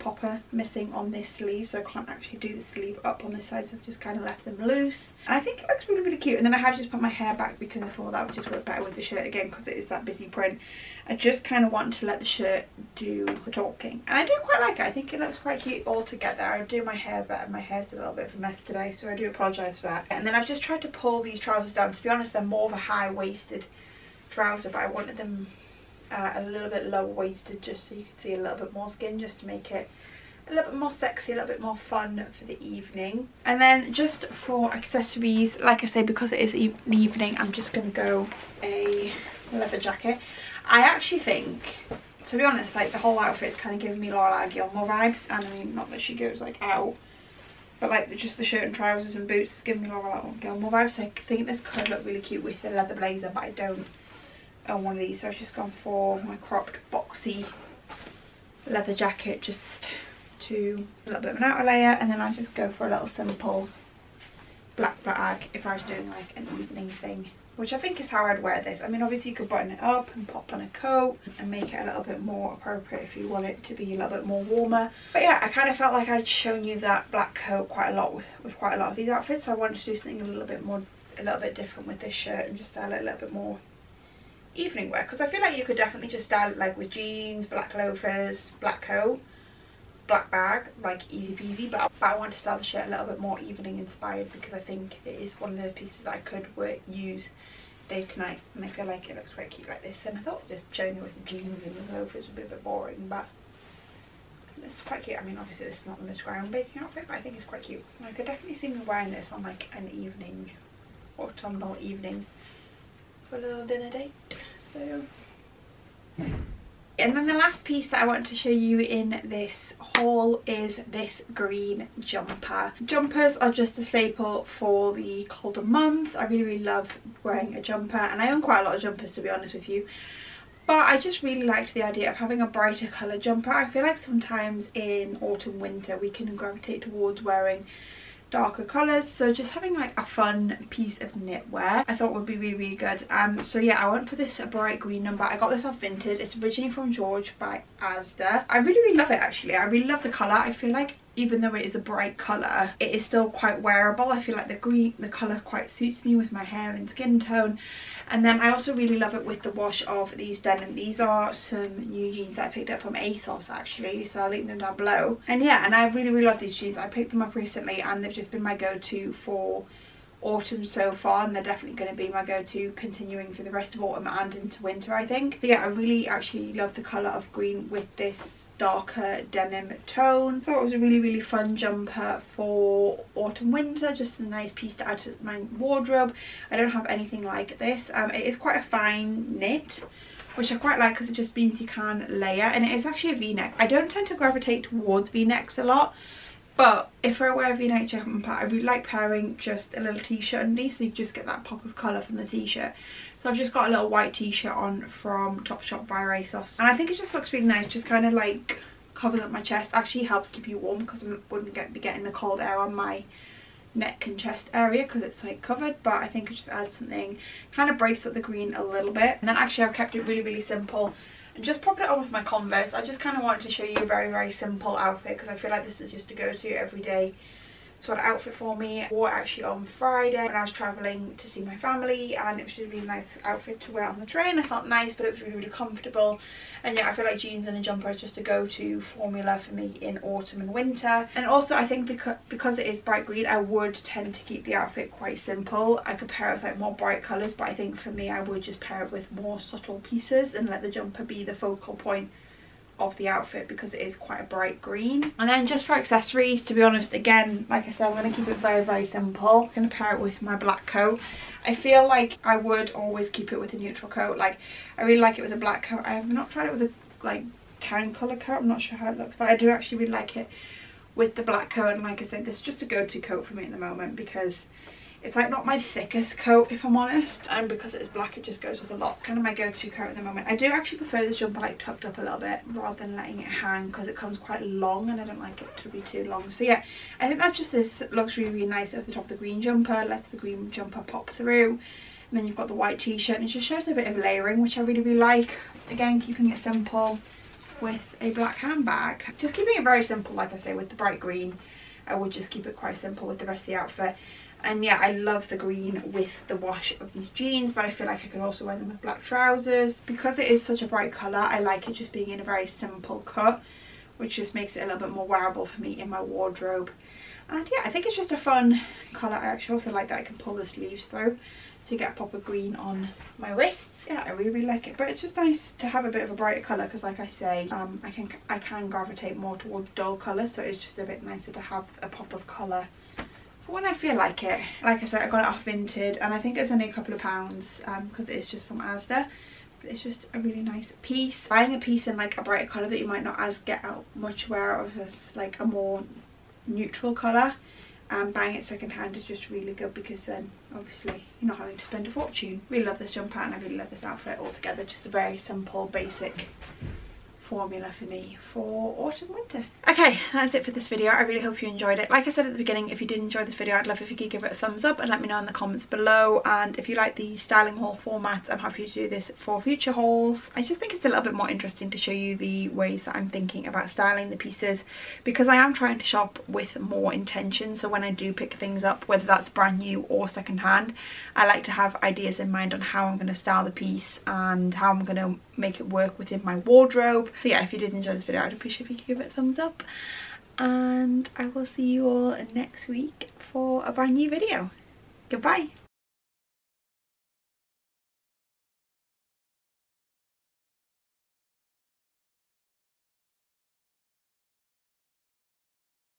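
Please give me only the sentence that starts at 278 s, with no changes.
It's kind of my go-to coat at the moment.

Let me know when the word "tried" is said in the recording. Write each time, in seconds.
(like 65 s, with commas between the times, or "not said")
20 s, 266 s.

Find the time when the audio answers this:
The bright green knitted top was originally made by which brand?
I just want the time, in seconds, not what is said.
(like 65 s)
146 s.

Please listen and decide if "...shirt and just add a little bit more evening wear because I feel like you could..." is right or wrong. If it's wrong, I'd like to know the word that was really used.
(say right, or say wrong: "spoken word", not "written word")
right.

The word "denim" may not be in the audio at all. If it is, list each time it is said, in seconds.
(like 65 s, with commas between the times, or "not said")
160 s, 179 s.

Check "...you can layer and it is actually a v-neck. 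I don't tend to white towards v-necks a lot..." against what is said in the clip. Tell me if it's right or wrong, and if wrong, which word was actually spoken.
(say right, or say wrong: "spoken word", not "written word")
wrong: "gravitate", not "white".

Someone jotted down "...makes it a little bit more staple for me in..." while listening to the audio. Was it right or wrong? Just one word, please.
wrong.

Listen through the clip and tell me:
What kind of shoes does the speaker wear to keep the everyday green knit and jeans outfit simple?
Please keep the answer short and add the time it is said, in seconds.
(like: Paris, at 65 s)
Converse, at 222 s.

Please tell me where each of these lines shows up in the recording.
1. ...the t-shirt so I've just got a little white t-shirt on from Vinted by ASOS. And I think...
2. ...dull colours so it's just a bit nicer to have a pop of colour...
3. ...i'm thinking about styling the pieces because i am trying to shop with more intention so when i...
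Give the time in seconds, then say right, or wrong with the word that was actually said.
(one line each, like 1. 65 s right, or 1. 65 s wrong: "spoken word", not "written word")
1. 202 s wrong: "Topshop", not "Vinted"
2. 329 s right
3. 372 s right.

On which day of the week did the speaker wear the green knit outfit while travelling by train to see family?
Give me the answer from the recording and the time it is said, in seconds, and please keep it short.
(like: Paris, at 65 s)
Friday, at 229 s.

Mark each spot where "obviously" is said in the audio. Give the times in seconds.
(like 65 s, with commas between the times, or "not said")
69 s, 105 s, 350 s.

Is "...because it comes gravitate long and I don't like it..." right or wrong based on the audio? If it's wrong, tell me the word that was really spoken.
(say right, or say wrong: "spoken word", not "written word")
wrong: "quite", not "gravitate".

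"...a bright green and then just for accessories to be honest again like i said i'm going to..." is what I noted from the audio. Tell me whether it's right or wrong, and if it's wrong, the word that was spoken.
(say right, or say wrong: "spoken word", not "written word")
right.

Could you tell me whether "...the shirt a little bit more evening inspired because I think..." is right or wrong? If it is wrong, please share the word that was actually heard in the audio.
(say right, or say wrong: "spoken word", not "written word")
right.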